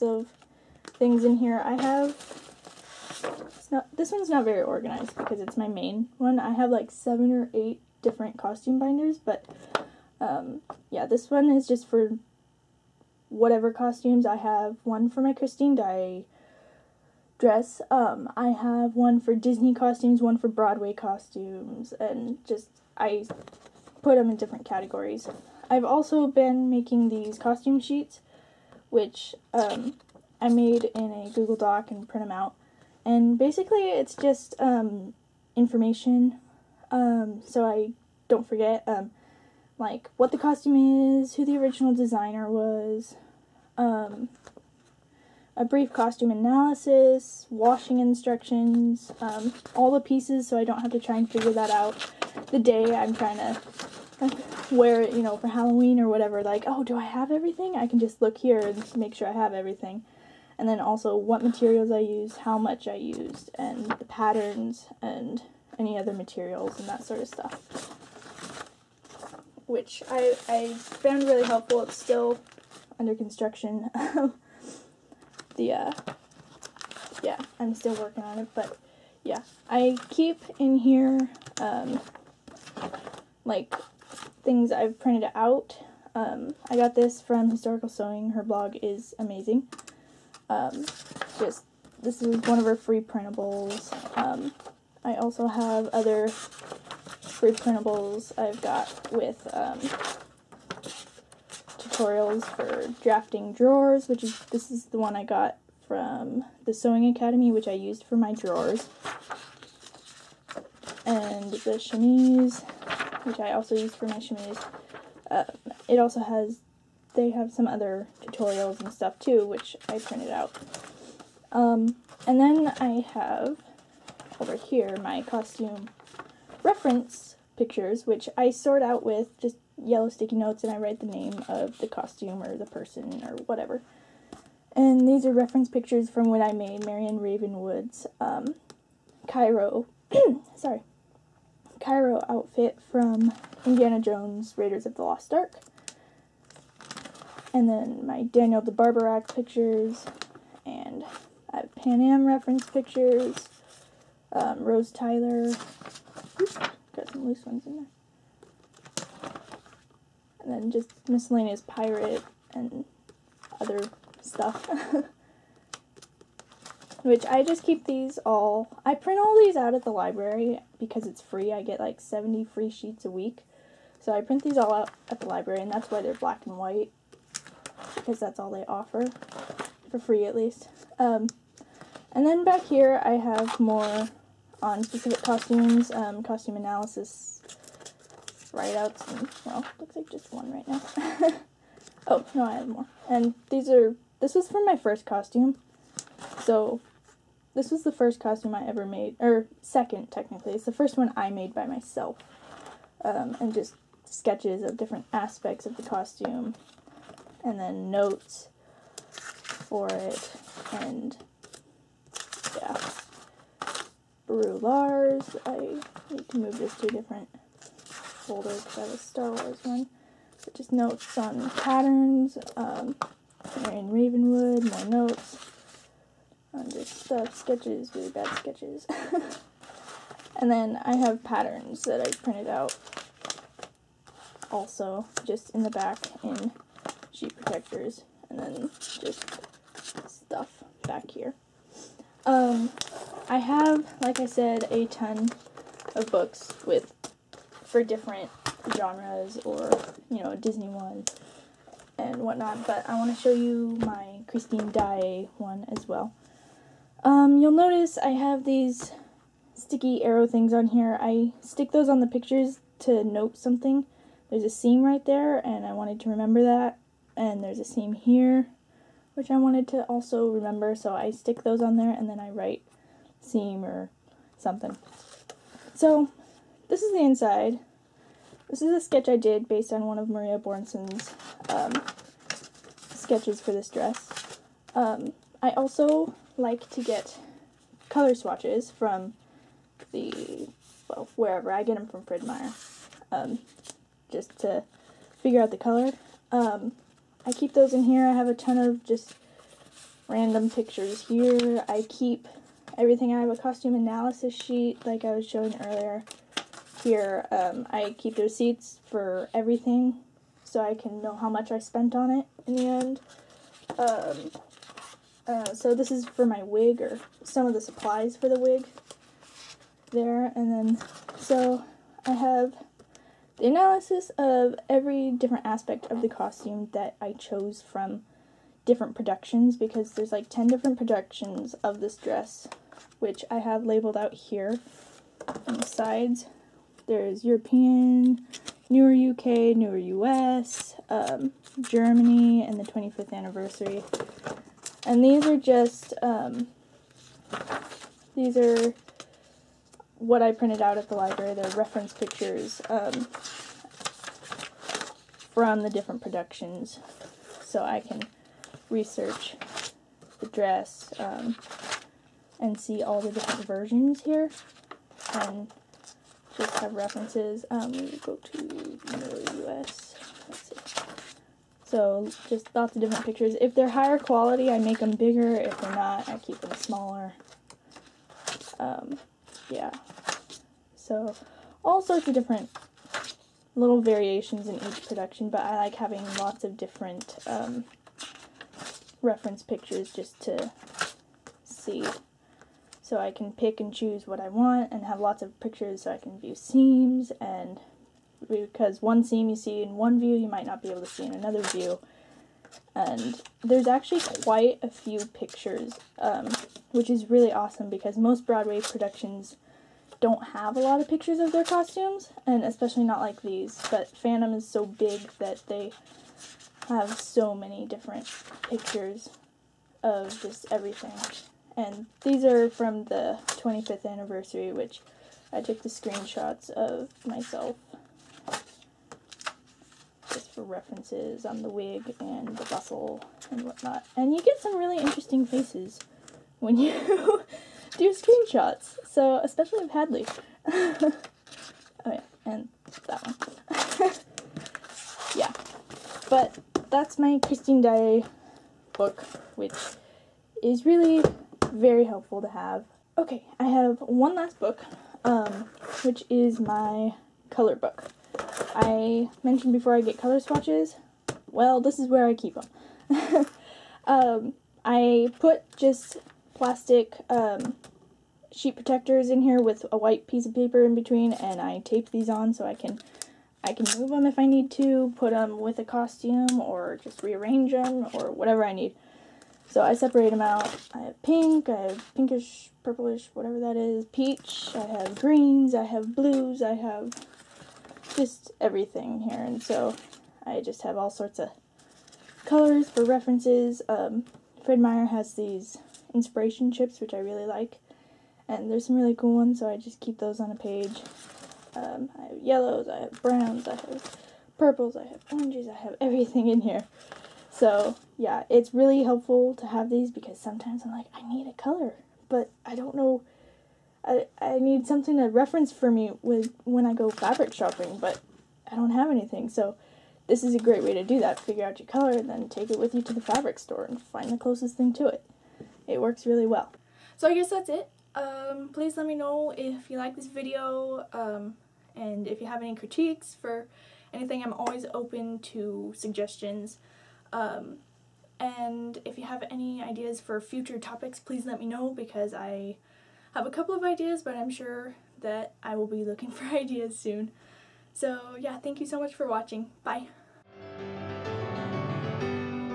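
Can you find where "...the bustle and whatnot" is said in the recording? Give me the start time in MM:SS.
07:12.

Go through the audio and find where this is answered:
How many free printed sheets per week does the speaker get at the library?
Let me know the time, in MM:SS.
02:51.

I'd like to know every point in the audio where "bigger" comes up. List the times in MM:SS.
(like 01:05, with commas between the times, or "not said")
06:14.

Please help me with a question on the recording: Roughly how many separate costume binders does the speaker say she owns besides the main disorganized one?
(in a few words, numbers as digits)
7 or 8.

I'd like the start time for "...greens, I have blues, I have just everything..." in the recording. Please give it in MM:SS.
08:04.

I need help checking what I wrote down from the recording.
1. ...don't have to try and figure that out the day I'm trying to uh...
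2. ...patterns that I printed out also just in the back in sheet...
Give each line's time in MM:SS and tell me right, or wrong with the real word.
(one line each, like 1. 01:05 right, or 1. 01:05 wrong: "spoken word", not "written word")
1. 00:50 right
2. 03:51 right.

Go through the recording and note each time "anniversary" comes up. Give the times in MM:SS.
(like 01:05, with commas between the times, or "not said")
05:43, 07:03.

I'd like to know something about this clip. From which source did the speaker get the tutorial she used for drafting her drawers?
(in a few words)
the Sewing Academy.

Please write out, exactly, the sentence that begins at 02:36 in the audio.
Oops, got some loose ones in there and then just miscellaneous pirate and other stuff.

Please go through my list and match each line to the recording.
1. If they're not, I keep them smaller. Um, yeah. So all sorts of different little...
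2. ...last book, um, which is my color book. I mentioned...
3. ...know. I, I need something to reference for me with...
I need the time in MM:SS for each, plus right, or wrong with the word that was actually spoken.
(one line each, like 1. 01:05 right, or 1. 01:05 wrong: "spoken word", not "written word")
1. 06:15 right
2. 07:34 right
3. 08:32 right.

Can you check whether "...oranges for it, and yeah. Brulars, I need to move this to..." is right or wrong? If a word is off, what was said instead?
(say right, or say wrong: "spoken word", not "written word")
wrong: "notes", not "oranges".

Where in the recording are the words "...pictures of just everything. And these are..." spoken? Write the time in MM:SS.
06:58.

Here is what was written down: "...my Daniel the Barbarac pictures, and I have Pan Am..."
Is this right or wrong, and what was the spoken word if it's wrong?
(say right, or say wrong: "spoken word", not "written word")
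right.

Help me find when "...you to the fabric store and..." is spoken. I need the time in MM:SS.
08:42.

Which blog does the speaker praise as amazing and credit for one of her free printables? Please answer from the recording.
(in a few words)
Historical Sewing.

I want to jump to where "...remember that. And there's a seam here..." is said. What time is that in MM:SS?
04:26.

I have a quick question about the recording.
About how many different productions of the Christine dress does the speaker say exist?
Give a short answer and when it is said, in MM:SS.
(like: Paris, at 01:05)
10, at 05:30.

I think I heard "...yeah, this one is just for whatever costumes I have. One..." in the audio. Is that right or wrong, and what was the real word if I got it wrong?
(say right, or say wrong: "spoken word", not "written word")
right.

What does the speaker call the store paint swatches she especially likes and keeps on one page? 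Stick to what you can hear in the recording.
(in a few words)
inspiration chips.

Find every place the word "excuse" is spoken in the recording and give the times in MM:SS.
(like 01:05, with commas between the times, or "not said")
not said.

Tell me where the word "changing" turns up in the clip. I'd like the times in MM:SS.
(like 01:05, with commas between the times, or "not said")
not said.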